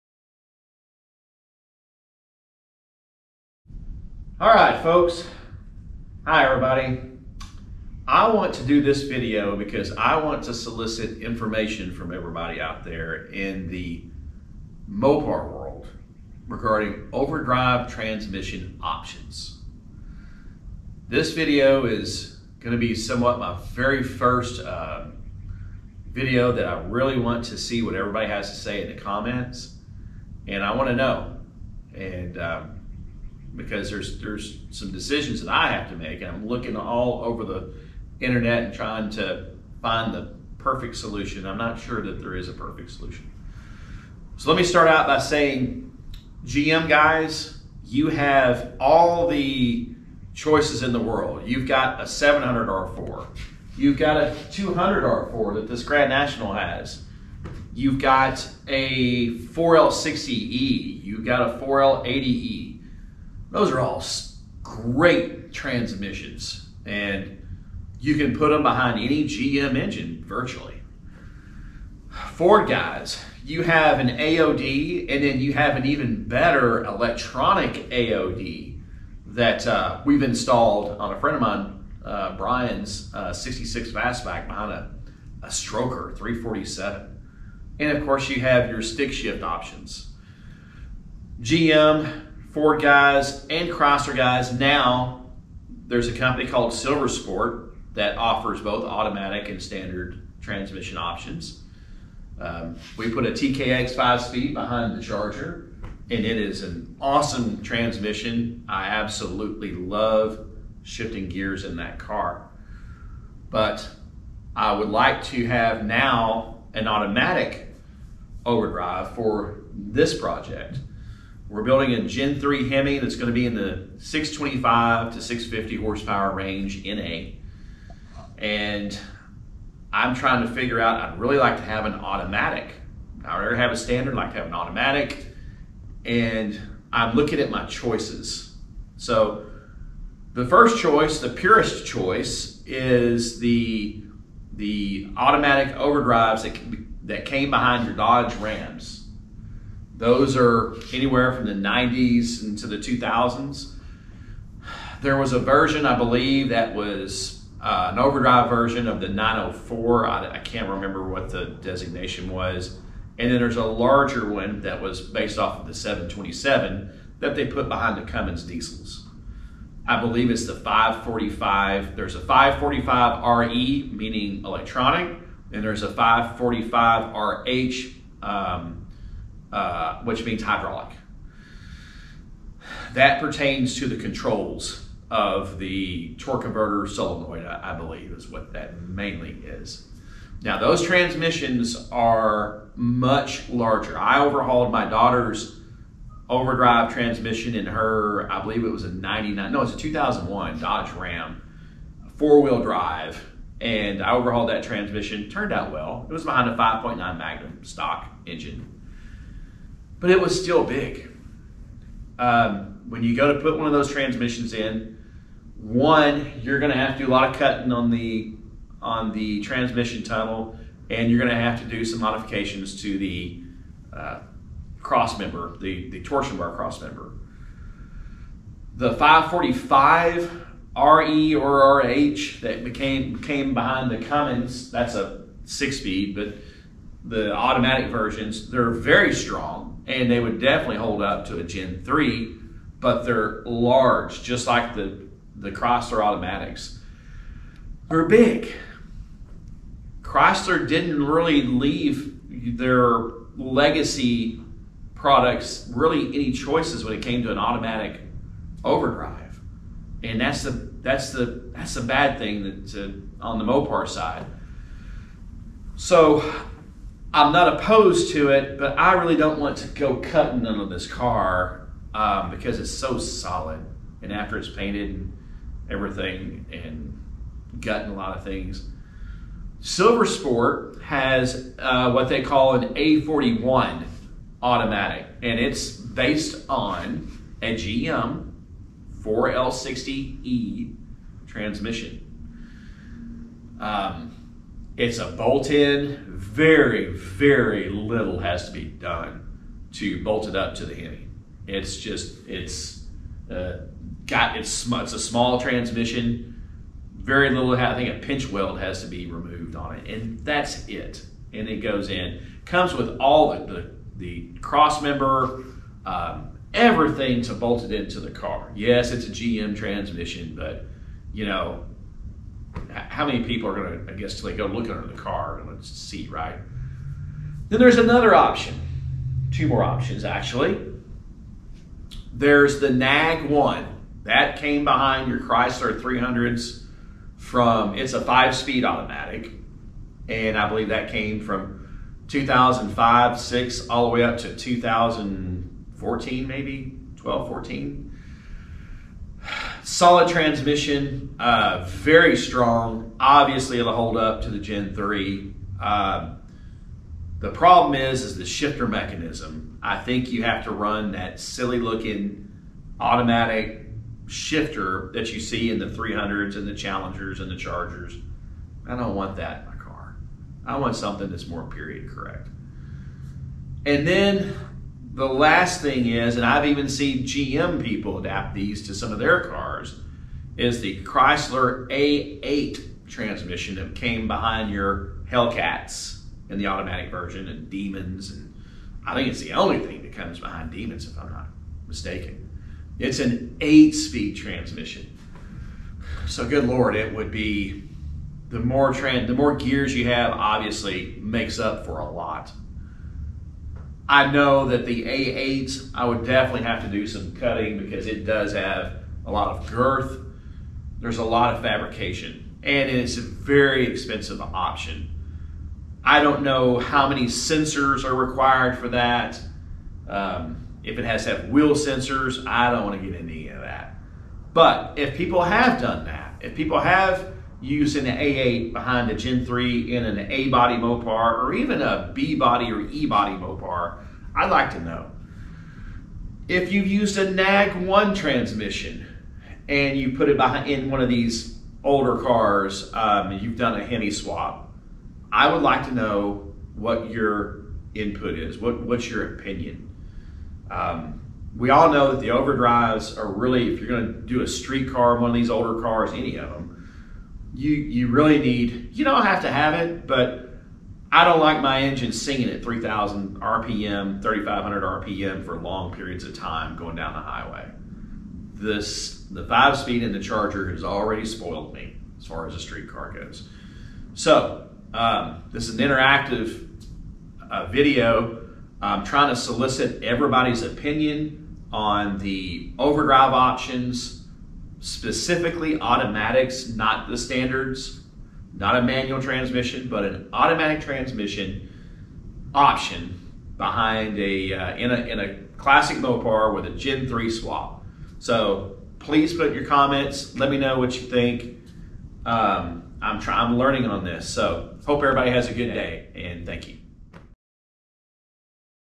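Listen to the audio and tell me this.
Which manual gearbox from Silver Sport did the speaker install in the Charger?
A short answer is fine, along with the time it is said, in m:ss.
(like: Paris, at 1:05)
TKX 5 speed, at 1:43.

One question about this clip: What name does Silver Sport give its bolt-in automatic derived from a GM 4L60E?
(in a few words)
A41.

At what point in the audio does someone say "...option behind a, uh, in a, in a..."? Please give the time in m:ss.
8:12.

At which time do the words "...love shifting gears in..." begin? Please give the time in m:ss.
1:49.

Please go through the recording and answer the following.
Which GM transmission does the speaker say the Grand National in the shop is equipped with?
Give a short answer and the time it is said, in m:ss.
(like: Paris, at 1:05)
200 R4, at 0:54.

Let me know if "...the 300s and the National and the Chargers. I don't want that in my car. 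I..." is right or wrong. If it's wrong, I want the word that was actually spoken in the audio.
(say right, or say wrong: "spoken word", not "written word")
wrong: "Challengers", not "National".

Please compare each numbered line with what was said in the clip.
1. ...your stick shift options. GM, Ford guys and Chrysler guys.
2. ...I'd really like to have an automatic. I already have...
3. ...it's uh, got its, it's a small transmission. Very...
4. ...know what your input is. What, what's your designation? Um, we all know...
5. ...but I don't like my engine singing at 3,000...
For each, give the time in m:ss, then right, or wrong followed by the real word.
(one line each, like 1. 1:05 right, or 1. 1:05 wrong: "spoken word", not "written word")
1. 1:28 right
2. 2:11 right
3. 5:02 right
4. 7:25 wrong: "opinion", not "designation"
5. 7:39 right.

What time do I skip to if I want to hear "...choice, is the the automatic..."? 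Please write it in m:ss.
2:21.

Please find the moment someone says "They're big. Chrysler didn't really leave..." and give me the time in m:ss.
4:07.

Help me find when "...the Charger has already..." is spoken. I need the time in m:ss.
7:49.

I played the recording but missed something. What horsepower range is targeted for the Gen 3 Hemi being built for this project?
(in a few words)
625 to 650.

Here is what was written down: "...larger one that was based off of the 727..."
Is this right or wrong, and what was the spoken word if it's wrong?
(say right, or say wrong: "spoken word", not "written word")
right.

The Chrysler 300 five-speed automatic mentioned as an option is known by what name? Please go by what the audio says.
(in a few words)
NAG one.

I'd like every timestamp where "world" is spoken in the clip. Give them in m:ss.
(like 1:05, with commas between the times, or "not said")
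0:15, 0:50.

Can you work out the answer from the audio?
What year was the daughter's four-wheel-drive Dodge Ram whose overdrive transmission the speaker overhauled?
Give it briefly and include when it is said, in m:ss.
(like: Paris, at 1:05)
2001, at 3:19.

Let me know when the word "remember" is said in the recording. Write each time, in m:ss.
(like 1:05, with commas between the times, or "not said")
2:40.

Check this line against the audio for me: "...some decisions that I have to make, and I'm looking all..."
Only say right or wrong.
right.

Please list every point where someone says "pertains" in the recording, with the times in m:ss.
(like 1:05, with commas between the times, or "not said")
3:03.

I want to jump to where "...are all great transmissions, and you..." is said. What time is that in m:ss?
1:03.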